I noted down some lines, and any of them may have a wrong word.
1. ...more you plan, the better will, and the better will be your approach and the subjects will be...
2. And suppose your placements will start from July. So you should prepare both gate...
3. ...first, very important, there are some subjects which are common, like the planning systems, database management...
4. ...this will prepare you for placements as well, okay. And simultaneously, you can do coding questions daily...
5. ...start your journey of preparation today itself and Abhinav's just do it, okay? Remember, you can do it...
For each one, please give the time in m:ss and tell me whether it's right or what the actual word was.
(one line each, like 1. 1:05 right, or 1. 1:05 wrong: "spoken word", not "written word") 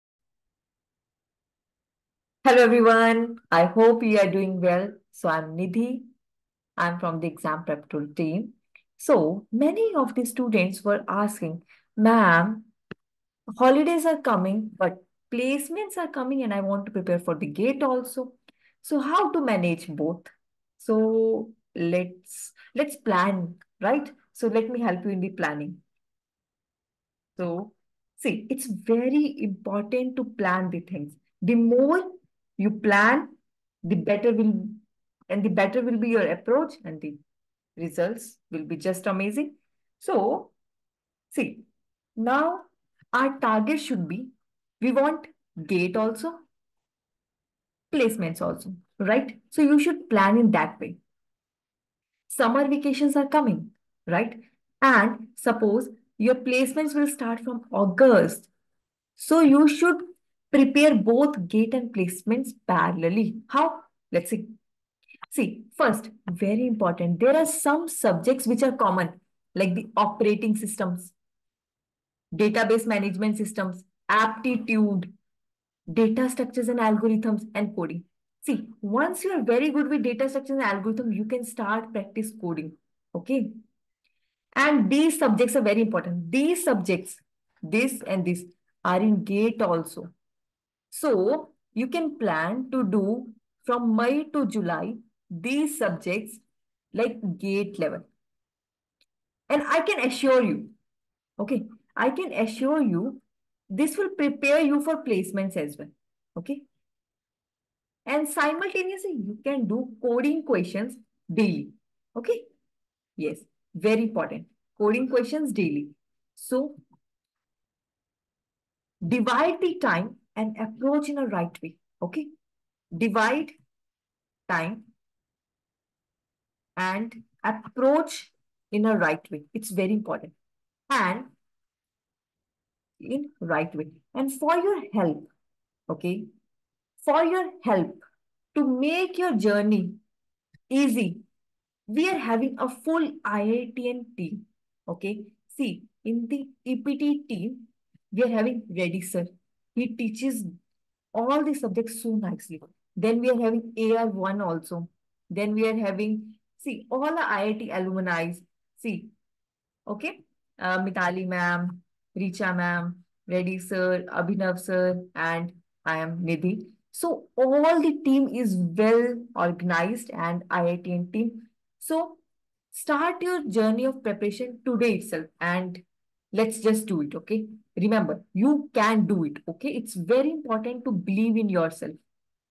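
1. 0:31 wrong: "results", not "subjects"
2. 0:54 wrong: "August", not "July"
3. 1:05 wrong: "operating", not "planning"
4. 1:43 right
5. 2:52 wrong: "Let", not "Abhinav".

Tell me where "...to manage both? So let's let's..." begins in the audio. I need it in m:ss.
0:19.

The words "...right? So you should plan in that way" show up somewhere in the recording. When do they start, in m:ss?
0:48.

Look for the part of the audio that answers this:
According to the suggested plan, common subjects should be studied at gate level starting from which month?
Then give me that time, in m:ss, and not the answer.
1:33.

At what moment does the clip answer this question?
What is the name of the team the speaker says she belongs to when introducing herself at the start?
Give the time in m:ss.
0:07.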